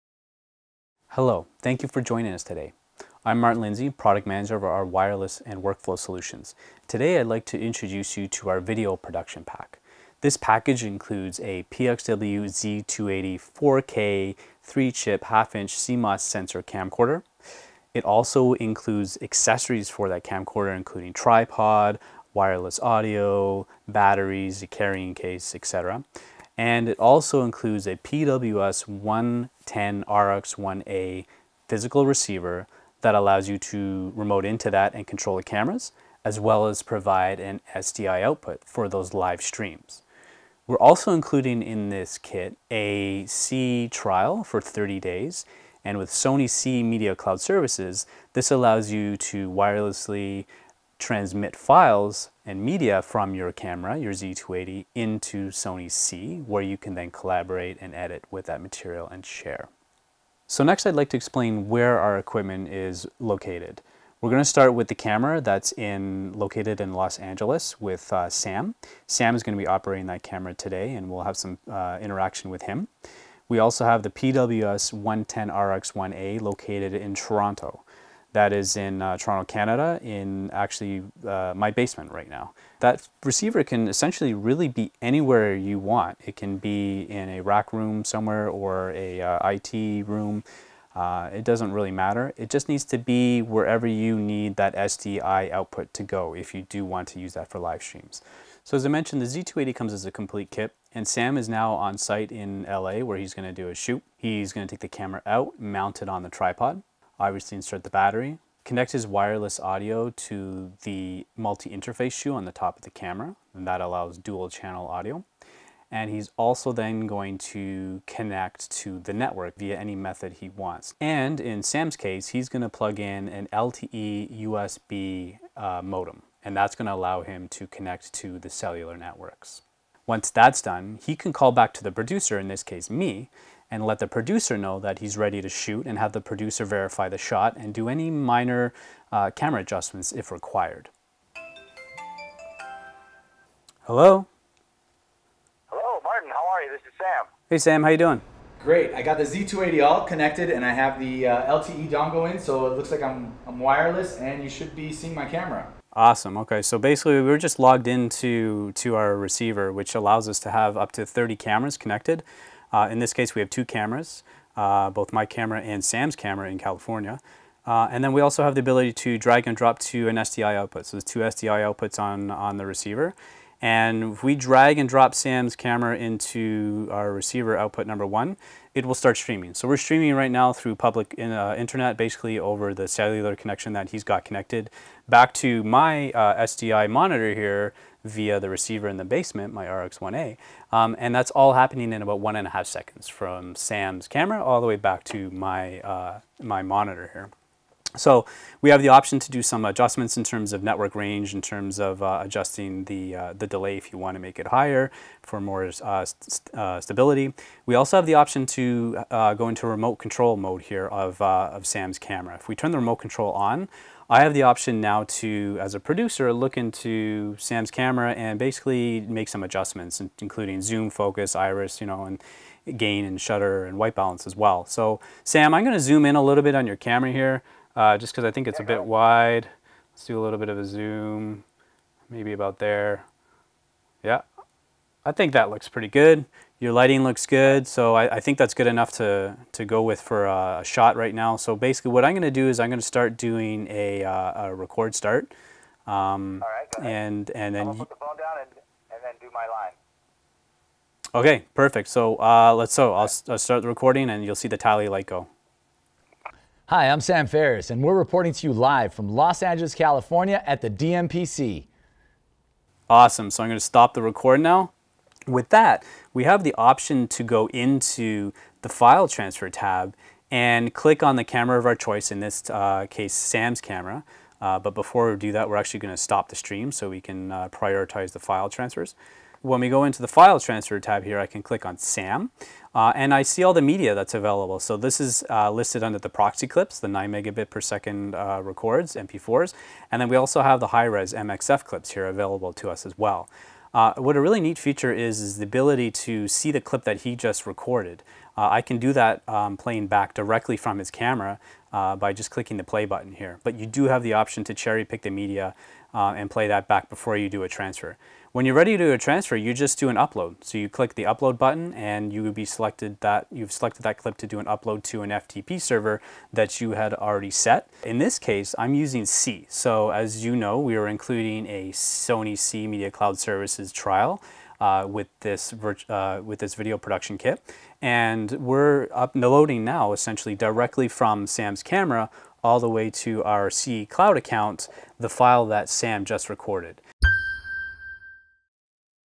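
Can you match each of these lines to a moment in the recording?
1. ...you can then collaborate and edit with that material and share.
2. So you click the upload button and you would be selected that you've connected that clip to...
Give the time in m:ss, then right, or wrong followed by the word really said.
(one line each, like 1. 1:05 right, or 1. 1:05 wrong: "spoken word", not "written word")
1. 0:56 right
2. 5:10 wrong: "selected", not "connected".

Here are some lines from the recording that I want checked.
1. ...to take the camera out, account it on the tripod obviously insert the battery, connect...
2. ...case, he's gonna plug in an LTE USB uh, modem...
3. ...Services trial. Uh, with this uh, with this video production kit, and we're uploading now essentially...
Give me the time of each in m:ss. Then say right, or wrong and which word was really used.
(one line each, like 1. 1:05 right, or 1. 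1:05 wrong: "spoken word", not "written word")
1. 1:44 wrong: "mount", not "account"
2. 2:01 right
3. 5:23 right.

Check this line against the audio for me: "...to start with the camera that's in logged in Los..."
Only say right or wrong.
wrong.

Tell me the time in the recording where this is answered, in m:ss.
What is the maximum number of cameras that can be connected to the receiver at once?
2:41.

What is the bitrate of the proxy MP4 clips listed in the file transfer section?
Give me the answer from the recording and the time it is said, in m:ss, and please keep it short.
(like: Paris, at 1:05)
9 megabits per second, at 4:46.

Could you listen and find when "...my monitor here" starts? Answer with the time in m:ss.
3:16.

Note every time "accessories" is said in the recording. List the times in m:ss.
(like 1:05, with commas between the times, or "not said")
0:19.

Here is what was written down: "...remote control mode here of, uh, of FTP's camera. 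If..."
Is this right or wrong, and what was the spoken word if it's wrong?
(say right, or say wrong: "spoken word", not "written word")
wrong: "Sam", not "FTP".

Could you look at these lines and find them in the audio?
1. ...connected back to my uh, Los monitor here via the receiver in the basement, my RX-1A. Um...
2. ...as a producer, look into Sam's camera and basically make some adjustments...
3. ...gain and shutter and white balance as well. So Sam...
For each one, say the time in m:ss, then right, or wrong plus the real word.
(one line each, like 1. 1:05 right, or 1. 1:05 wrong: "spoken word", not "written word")
1. 3:04 wrong: "SDI", not "Los"
2. 3:35 right
3. 3:42 right.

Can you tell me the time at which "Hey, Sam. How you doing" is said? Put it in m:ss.
2:27.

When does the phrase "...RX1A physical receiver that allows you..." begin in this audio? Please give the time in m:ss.
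0:30.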